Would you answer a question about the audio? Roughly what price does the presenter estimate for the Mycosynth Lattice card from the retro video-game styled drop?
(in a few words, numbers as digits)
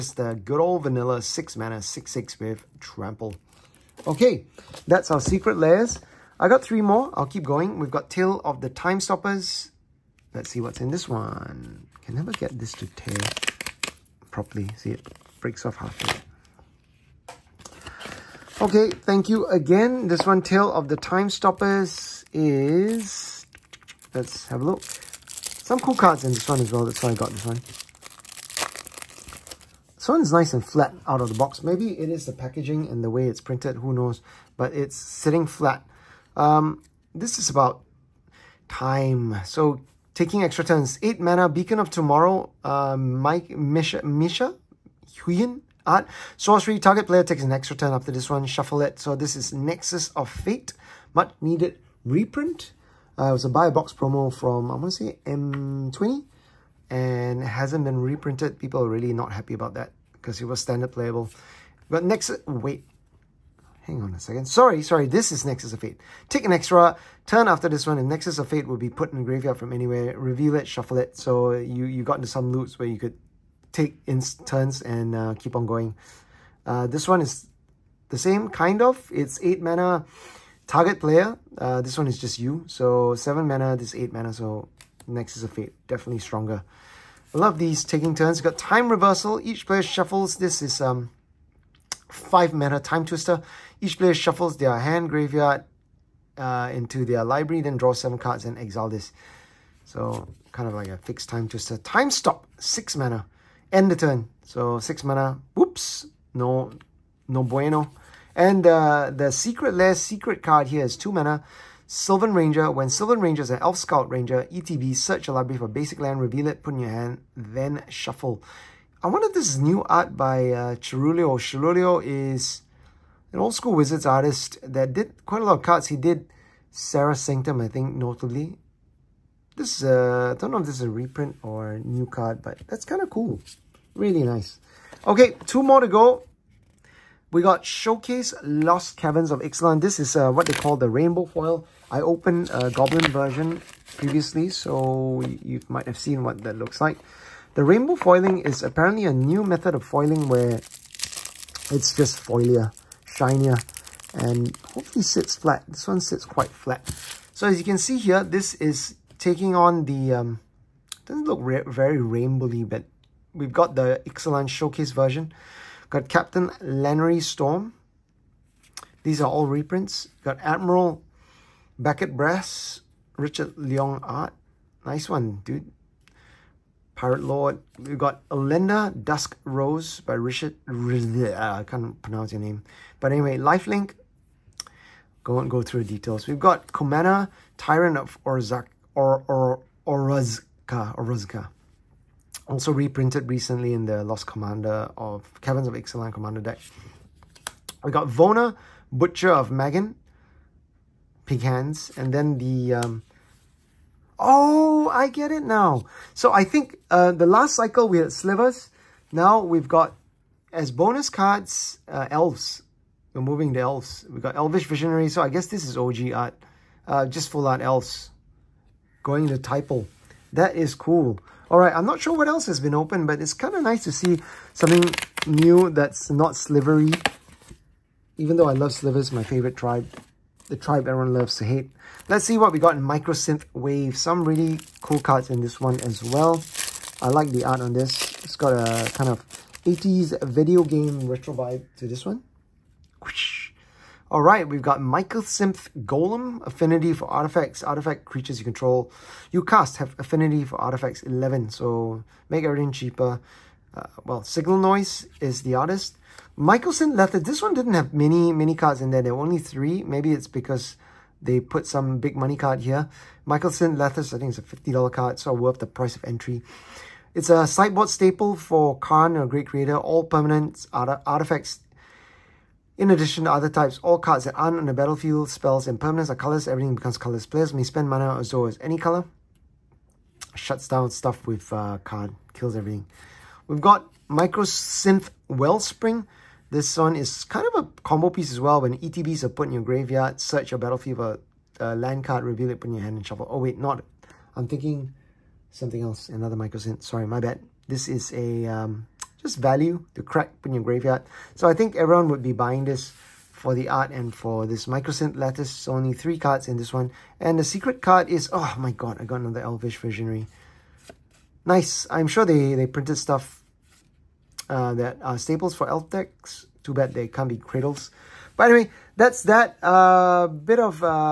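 $50.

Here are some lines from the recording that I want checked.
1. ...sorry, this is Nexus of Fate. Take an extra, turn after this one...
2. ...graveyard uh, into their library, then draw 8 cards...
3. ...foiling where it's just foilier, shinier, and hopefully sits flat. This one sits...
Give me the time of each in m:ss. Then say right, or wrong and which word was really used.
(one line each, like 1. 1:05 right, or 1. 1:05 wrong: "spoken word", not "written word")
1. 1:04 right
2. 1:35 wrong: "7", not "8"
3. 2:29 right.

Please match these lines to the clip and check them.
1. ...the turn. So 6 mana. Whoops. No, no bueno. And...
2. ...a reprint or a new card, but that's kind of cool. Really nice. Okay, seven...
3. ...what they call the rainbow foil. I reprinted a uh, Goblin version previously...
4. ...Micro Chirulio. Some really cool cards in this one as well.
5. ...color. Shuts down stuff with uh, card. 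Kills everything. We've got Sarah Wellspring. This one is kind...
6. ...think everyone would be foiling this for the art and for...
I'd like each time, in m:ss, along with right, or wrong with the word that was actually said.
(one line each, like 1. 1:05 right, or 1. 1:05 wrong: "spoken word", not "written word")
1. 1:43 right
2. 2:10 wrong: "two", not "seven"
3. 2:20 wrong: "opened", not "reprinted"
4. 3:52 wrong: "Wave", not "Chirulio"
5. 4:38 wrong: "Mycosynth", not "Sarah"
6. 5:01 wrong: "buying", not "foiling".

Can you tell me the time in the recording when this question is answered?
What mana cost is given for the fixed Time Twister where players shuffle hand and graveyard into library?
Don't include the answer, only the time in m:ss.
1:32.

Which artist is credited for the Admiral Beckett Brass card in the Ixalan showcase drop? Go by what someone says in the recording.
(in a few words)
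Richard Leong.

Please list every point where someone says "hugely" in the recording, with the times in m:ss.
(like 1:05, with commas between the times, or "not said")
not said.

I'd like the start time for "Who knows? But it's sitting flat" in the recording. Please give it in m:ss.
0:33.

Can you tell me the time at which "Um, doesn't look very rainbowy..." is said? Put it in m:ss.
2:40.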